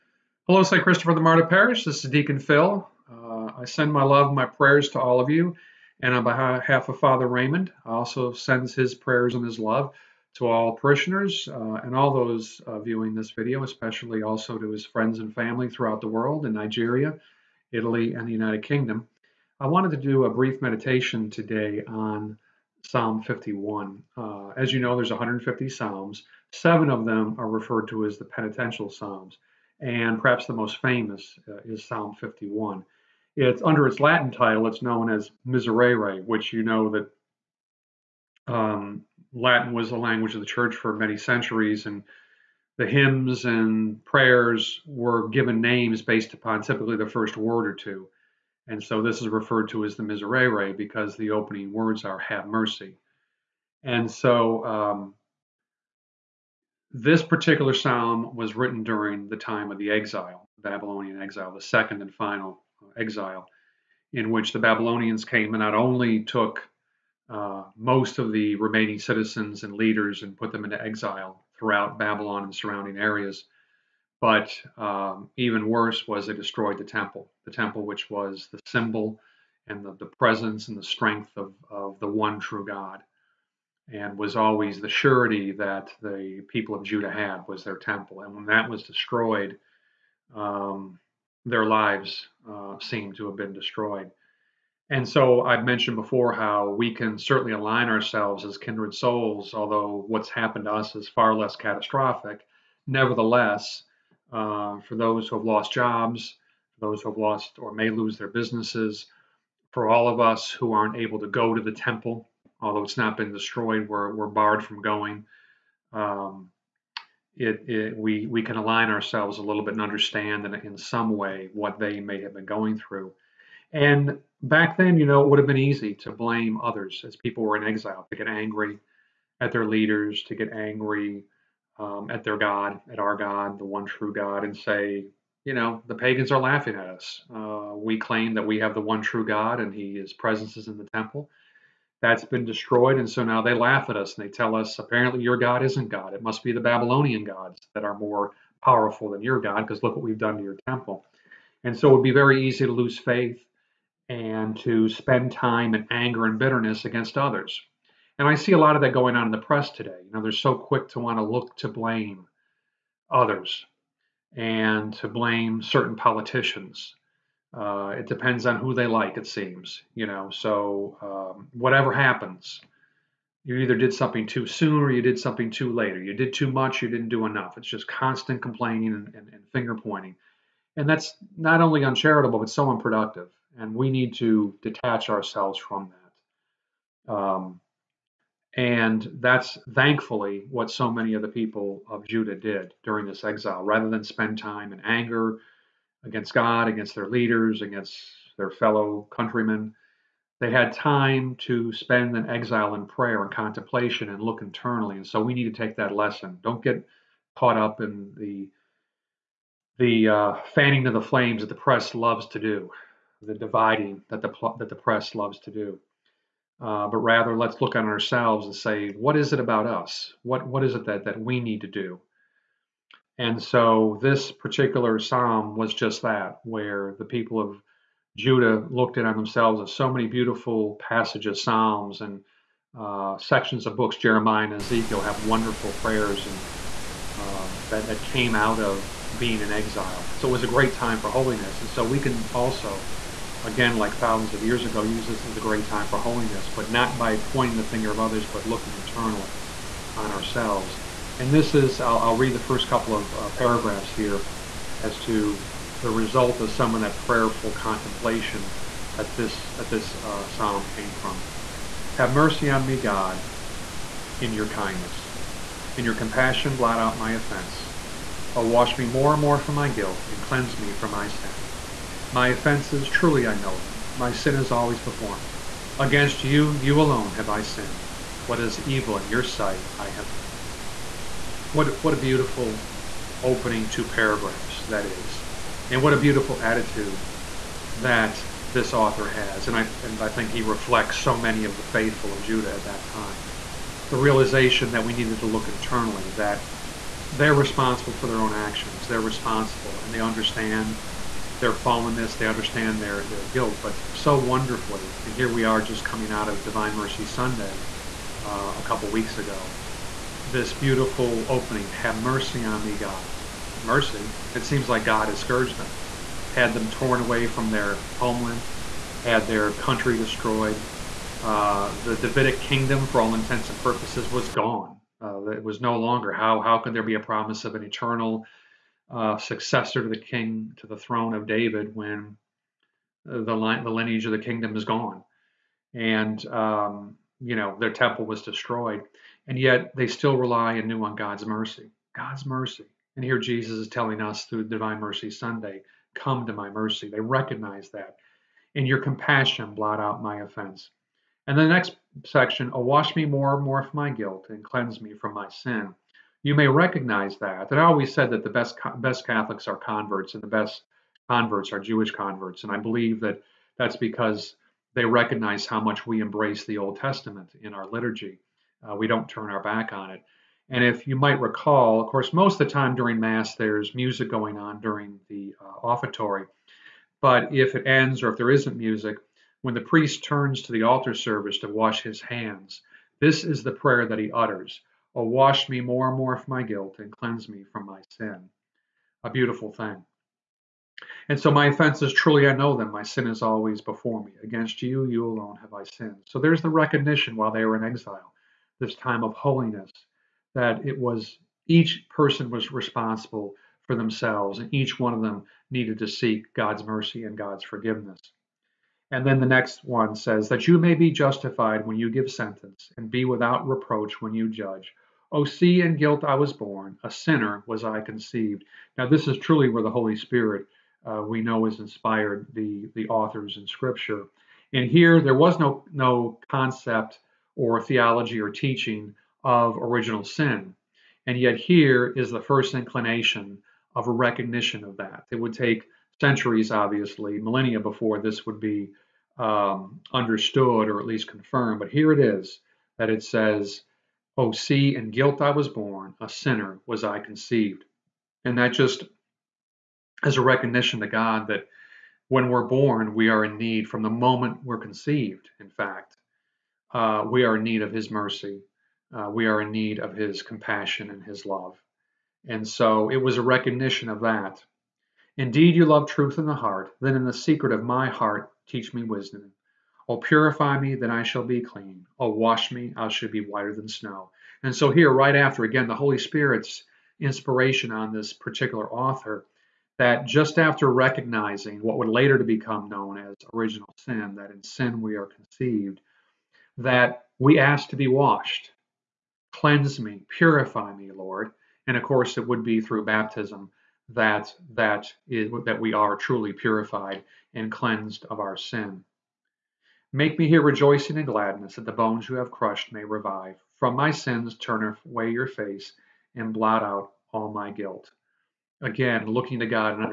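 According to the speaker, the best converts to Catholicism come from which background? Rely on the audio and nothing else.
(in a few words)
Jewish.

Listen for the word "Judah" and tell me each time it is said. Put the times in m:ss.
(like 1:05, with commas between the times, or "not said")
1:26, 3:12, 3:48, 4:52.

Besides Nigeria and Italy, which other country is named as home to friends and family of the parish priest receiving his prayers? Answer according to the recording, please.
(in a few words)
United Kingdom.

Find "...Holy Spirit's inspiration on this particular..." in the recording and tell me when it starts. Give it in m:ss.
7:55.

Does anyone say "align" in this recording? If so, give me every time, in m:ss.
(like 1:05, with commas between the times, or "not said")
1:37, 1:58.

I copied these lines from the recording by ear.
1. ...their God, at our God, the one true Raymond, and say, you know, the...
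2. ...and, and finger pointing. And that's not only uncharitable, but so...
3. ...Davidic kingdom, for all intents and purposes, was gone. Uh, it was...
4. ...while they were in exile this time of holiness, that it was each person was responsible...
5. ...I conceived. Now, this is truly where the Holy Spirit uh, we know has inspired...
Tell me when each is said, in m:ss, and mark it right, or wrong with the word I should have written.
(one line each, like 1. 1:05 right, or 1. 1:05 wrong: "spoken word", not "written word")
1. 2:12 wrong: "God", not "Raymond"
2. 2:59 right
3. 5:21 right
4. 6:37 right
5. 6:57 right.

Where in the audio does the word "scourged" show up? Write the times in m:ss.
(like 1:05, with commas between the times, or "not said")
5:15.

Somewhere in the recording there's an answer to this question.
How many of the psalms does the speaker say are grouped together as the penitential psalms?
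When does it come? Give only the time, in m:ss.
0:26.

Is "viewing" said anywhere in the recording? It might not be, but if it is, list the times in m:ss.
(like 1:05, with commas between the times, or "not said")
0:12.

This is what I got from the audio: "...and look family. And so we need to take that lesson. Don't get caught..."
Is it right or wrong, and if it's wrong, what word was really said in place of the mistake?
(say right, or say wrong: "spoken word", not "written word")
wrong: "internally", not "family".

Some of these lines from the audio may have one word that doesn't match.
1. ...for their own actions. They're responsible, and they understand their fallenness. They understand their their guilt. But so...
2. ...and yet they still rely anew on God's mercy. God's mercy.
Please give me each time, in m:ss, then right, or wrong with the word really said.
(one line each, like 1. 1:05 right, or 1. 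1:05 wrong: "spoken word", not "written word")
1. 4:57 right
2. 5:39 right.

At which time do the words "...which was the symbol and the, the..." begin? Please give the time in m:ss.
1:17.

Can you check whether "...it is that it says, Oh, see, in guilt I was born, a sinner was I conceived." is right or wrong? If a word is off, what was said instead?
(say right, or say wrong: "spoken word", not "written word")
right.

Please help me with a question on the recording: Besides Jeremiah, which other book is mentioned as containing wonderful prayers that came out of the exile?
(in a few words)
Ezekiel.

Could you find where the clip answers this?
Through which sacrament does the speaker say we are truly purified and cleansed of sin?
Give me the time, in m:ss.
8:12.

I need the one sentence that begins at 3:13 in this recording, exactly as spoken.
Rather than spend time in anger, against God, against their leaders, against their fellow countrymen.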